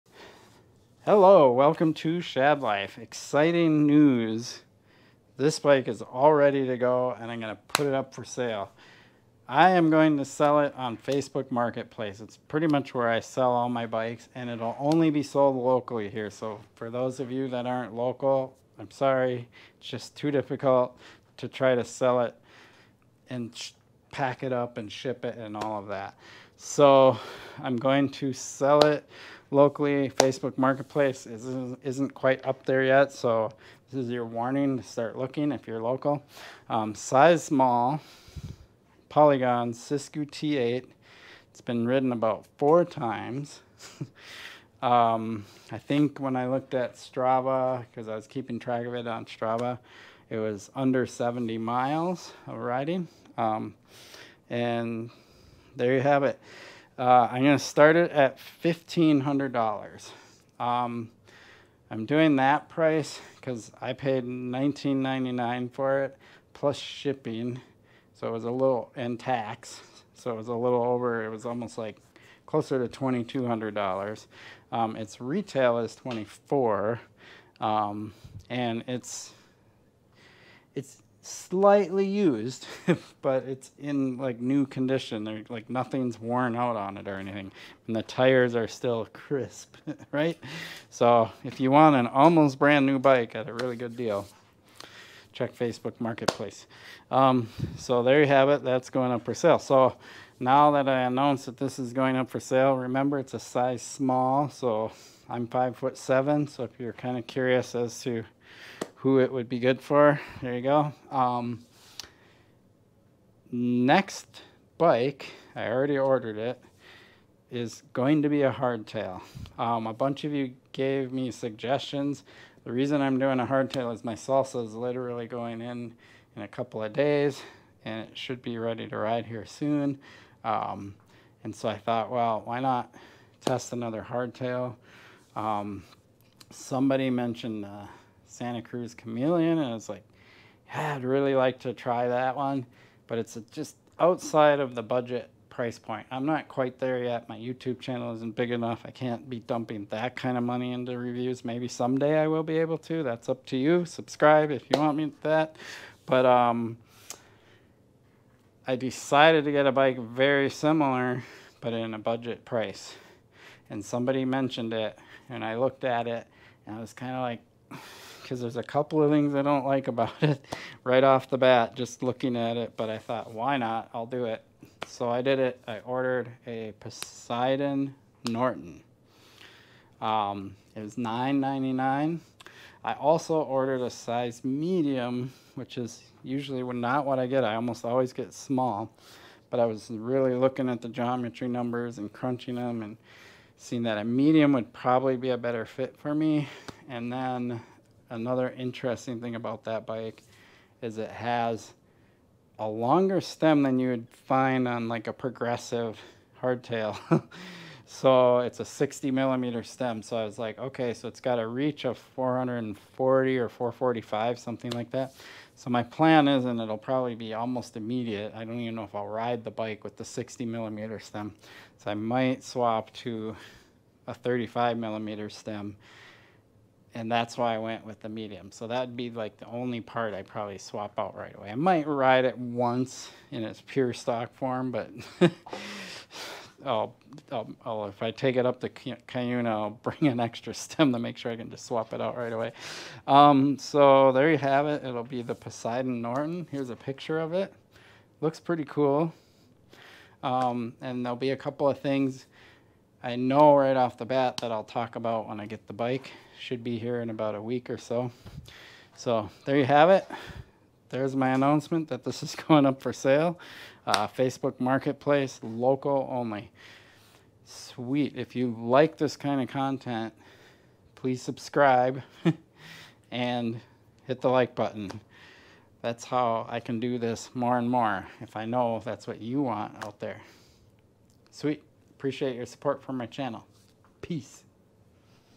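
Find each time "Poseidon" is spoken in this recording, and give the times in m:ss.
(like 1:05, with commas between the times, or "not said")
2:56, 4:05.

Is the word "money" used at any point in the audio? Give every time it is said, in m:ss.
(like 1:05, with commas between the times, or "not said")
2:30.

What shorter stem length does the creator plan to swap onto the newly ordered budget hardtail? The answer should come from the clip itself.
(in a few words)
35 millimeters.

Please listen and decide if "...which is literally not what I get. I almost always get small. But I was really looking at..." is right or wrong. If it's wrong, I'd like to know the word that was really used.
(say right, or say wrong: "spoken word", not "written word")
wrong: "usually", not "literally".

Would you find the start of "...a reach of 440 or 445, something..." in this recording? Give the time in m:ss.
3:31.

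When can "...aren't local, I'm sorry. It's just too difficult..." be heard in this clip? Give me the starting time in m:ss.
0:17.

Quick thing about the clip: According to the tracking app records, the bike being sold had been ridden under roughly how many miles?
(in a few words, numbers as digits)
70 miles.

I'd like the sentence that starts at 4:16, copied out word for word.
Should be here in about a week or so.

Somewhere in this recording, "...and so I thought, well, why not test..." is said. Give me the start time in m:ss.
2:11.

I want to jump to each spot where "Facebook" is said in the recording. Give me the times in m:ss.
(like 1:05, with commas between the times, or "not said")
0:10, 0:30, 1:35, 4:24.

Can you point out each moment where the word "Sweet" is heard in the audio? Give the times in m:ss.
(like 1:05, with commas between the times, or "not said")
4:27, 4:41.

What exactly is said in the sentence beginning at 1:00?
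Um, I'm doing that price because I paid $19.99 for it plus shipping.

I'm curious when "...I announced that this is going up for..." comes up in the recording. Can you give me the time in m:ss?
1:40.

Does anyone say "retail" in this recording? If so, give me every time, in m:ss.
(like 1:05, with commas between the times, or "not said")
1:15.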